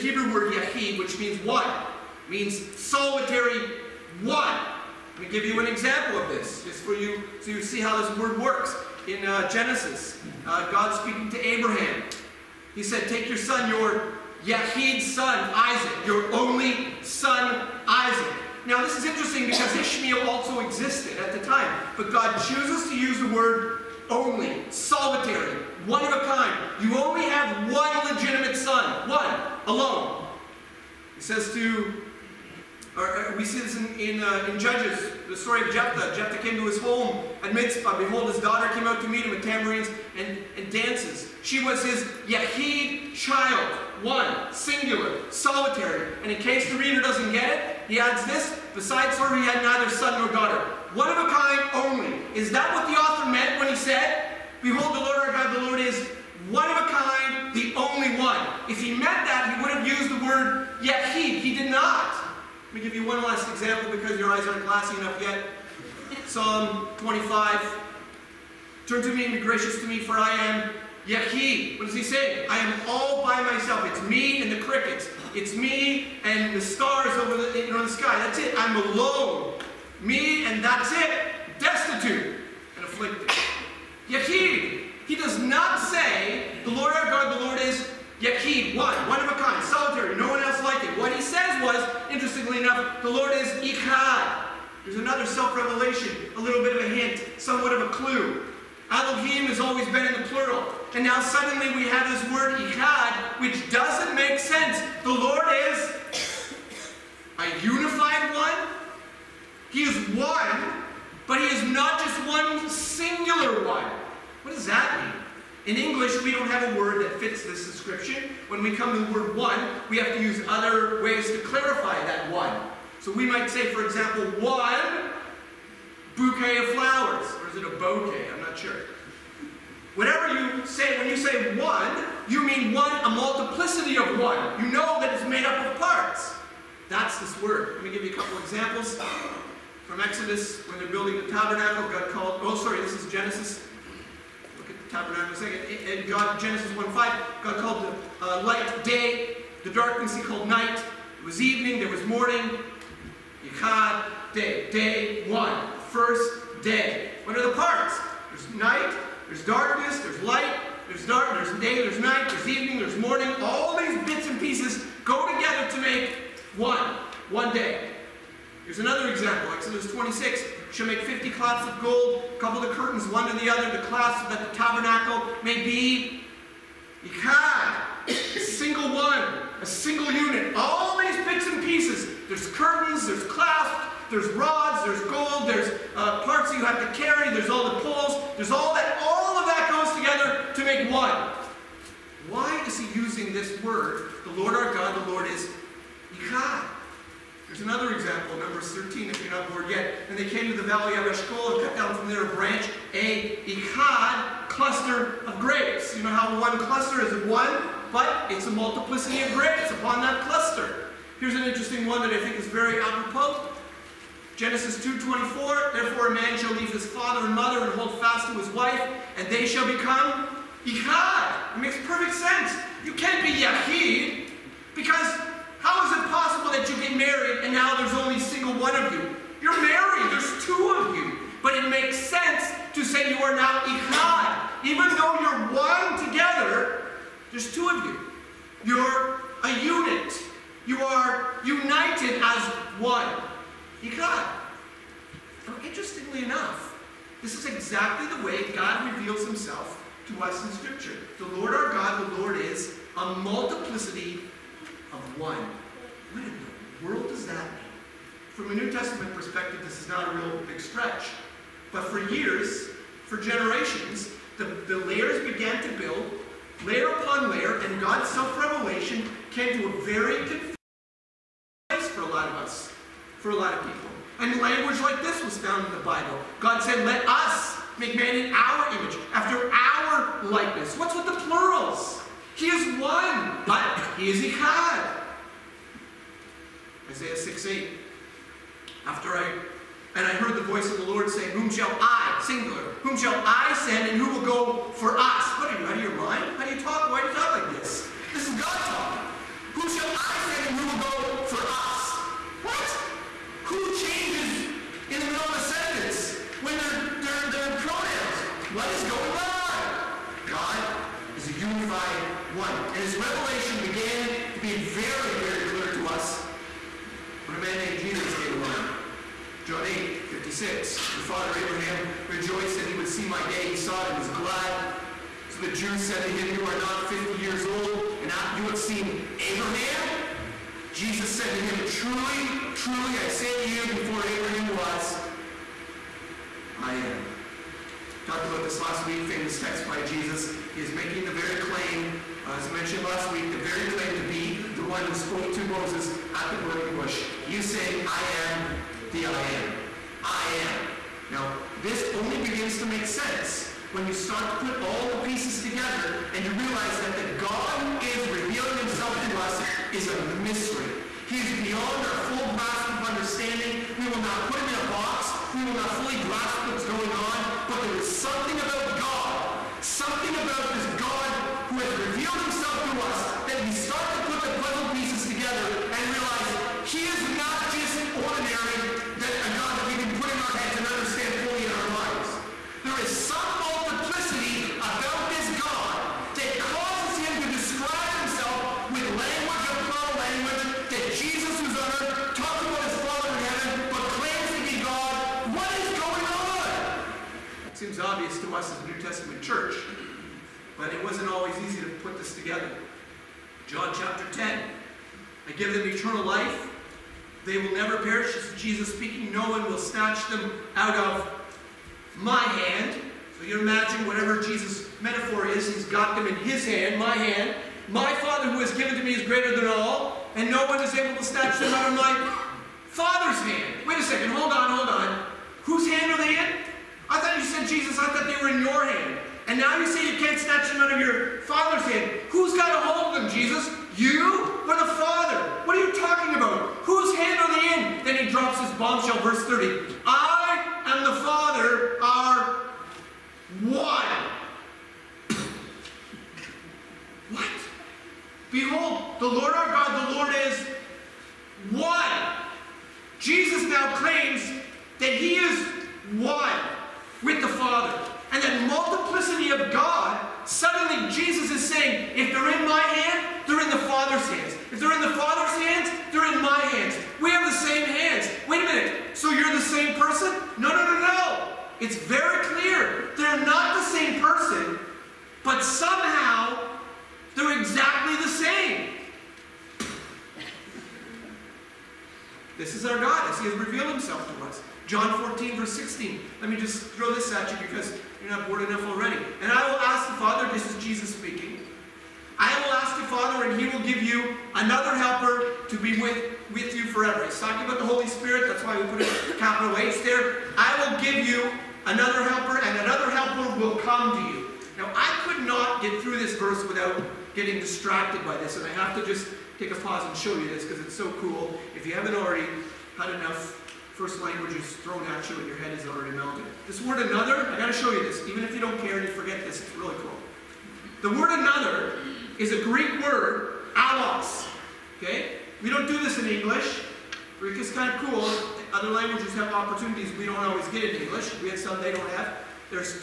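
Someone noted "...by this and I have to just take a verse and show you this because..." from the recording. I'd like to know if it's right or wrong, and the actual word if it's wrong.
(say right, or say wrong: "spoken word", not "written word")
wrong: "pause", not "verse".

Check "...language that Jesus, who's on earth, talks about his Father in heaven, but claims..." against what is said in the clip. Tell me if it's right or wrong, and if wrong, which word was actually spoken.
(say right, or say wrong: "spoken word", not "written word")
right.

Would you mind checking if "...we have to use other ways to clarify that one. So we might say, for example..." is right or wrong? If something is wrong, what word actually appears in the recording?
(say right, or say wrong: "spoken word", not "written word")
right.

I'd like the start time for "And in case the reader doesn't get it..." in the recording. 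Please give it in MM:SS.
00:46.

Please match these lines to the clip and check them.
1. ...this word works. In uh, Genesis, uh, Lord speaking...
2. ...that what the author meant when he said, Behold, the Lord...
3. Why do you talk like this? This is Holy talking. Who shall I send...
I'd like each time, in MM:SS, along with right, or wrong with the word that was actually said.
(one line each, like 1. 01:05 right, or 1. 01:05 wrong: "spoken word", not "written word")
1. 00:08 wrong: "God", not "Lord"
2. 00:52 right
3. 04:56 wrong: "God", not "Holy".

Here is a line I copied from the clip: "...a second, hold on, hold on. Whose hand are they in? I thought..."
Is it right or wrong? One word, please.
right.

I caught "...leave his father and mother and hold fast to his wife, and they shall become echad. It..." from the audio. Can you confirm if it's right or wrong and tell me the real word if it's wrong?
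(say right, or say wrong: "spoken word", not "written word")
right.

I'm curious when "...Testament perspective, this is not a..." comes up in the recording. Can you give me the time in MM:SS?
04:18.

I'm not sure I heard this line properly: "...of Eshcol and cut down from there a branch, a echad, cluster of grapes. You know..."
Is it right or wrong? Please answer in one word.
right.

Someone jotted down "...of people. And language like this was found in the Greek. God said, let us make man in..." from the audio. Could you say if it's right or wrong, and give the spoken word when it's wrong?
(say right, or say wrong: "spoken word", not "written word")
wrong: "Bible", not "Greek".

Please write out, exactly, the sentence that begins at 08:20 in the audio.
I will give you another helper and another helper will come to you.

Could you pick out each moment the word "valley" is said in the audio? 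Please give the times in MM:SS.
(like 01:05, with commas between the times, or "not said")
03:20.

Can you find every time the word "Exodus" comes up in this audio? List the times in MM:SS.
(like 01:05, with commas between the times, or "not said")
02:20, 02:49.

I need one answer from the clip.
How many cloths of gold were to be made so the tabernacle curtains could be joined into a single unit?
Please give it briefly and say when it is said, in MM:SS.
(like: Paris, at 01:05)
50, at 02:51.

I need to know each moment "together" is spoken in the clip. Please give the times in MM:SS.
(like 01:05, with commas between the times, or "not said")
02:45, 03:09, 03:56, 05:55, 06:15, 06:42.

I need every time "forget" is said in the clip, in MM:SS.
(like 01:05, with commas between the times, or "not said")
08:38.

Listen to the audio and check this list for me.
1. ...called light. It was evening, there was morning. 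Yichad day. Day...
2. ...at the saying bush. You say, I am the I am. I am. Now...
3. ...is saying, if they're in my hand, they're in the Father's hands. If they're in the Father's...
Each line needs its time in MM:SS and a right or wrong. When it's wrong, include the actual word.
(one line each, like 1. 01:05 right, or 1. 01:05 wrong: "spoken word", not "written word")
1. 02:30 wrong: "night", not "light"
2. 05:46 wrong: "burning", not "saying"
3. 07:41 right.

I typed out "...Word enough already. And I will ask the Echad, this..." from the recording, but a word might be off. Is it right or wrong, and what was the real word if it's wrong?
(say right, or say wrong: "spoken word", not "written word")
wrong: "Father", not "Echad".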